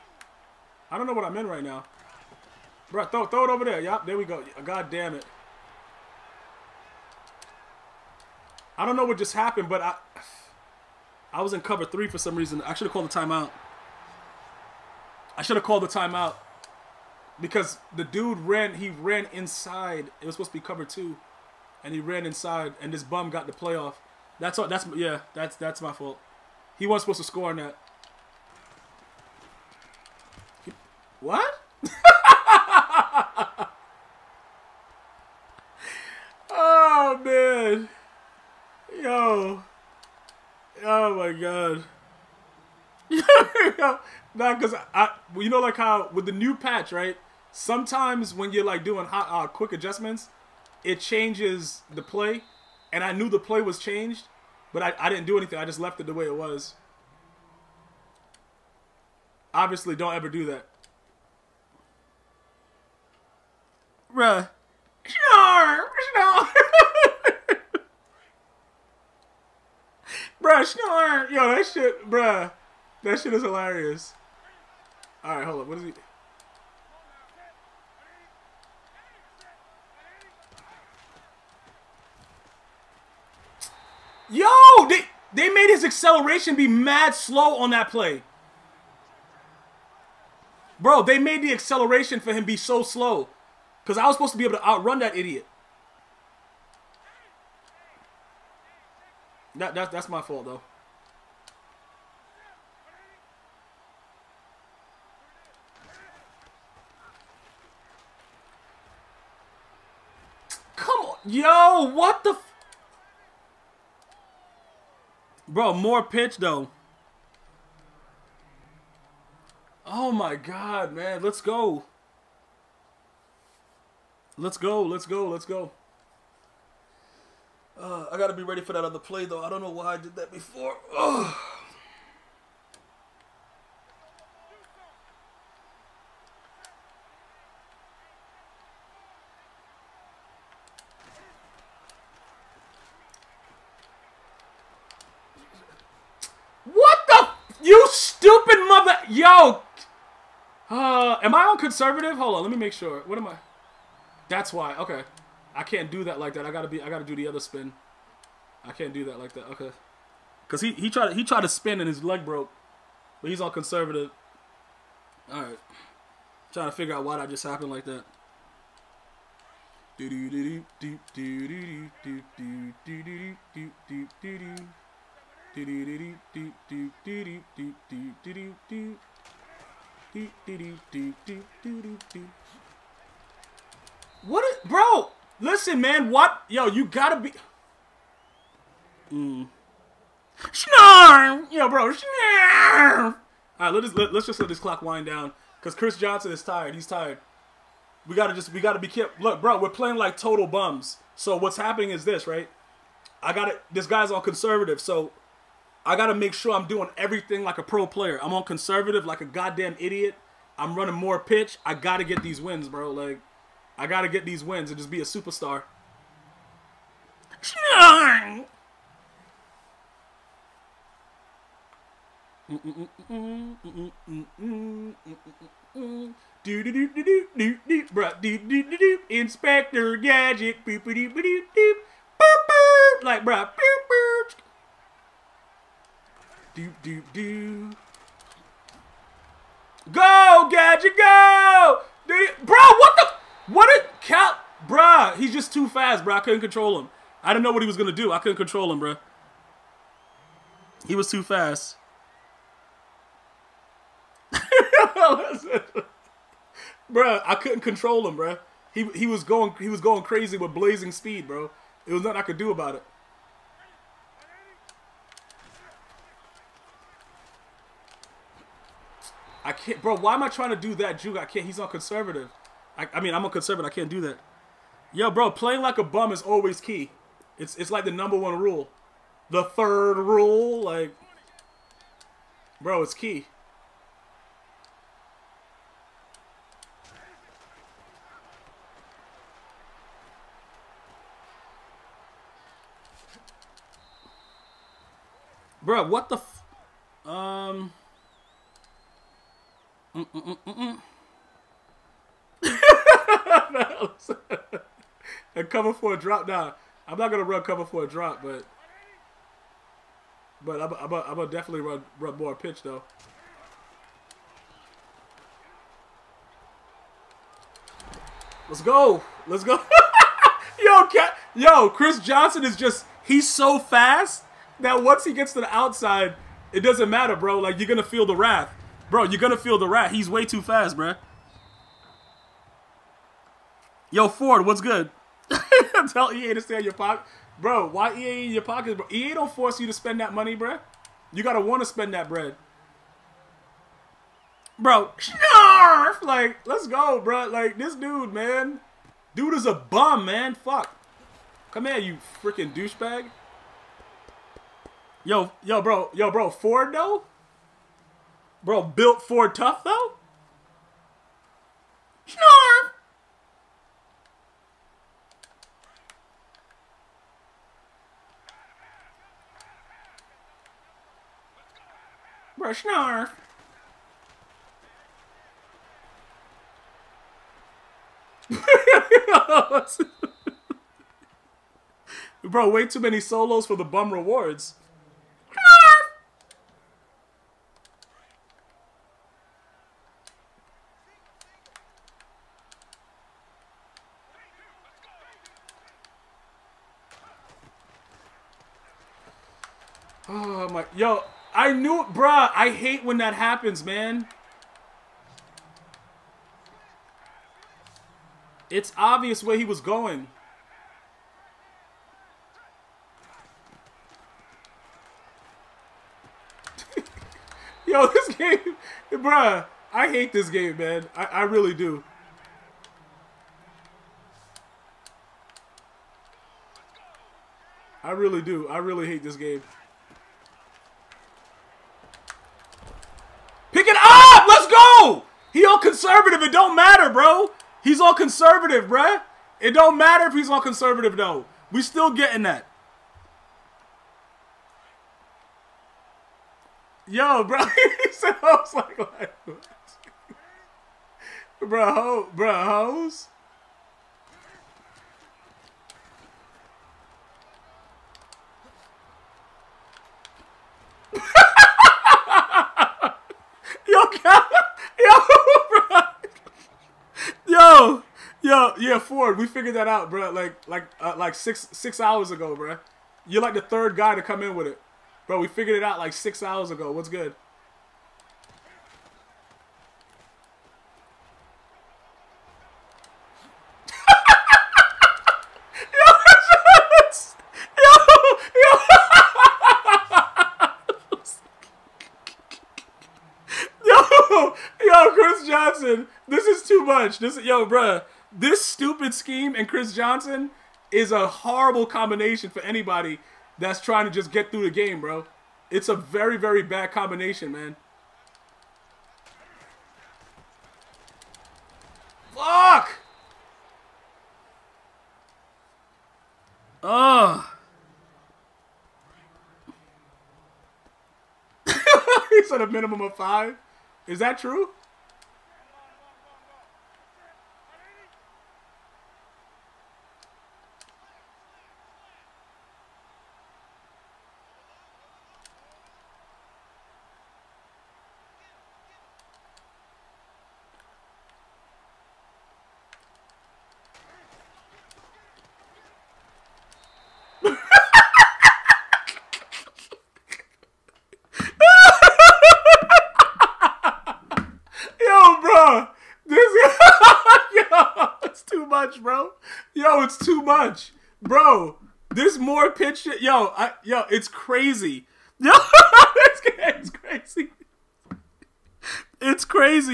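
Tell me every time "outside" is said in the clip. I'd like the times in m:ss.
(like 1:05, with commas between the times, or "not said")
5:25.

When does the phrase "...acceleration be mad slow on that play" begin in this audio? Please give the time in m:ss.
1:25.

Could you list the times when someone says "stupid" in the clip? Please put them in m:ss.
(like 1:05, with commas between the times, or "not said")
2:27, 8:18.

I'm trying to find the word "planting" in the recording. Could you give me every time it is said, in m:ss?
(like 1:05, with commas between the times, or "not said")
not said.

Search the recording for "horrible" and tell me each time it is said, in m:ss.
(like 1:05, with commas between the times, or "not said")
8:21.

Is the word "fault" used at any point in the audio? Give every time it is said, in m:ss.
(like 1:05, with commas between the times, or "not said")
0:25, 1:40.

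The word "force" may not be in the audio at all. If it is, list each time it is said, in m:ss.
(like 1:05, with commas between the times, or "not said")
5:39.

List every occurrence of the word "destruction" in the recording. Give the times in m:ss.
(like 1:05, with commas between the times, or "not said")
not said.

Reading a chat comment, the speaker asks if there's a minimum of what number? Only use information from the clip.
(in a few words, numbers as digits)
5.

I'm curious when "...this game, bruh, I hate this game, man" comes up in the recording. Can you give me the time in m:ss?
6:57.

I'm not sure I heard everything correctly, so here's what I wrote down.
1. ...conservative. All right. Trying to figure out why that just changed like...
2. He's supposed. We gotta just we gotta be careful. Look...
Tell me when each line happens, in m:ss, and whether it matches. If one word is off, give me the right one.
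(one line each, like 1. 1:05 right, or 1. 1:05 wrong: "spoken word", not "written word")
1. 2:43 wrong: "happened", not "changed"
2. 3:16 wrong: "tired", not "supposed".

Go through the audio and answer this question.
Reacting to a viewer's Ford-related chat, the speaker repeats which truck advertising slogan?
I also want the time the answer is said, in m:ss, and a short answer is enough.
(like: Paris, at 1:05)
Built for tough, at 5:58.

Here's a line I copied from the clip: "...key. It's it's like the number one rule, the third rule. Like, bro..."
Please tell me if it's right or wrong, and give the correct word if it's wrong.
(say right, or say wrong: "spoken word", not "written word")
right.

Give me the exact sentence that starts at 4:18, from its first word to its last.
He, he was going he was going crazy with blazing speed, bro.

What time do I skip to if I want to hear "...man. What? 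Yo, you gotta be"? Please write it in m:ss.
3:05.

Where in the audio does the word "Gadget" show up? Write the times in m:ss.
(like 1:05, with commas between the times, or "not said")
3:49, 4:00.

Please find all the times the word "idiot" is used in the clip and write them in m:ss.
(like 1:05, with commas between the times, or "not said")
1:35, 3:29.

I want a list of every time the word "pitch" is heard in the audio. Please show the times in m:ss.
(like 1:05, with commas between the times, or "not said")
1:56, 3:31, 5:12, 9:22.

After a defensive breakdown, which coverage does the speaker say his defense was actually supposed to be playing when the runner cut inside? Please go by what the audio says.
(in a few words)
Cover two.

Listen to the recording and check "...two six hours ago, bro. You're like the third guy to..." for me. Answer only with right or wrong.
wrong.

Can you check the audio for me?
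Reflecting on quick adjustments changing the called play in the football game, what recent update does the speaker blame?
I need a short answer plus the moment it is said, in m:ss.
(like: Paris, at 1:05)
The new patch, at 0:46.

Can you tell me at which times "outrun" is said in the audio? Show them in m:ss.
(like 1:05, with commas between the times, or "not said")
1:34.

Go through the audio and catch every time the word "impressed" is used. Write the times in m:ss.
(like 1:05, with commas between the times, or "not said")
not said.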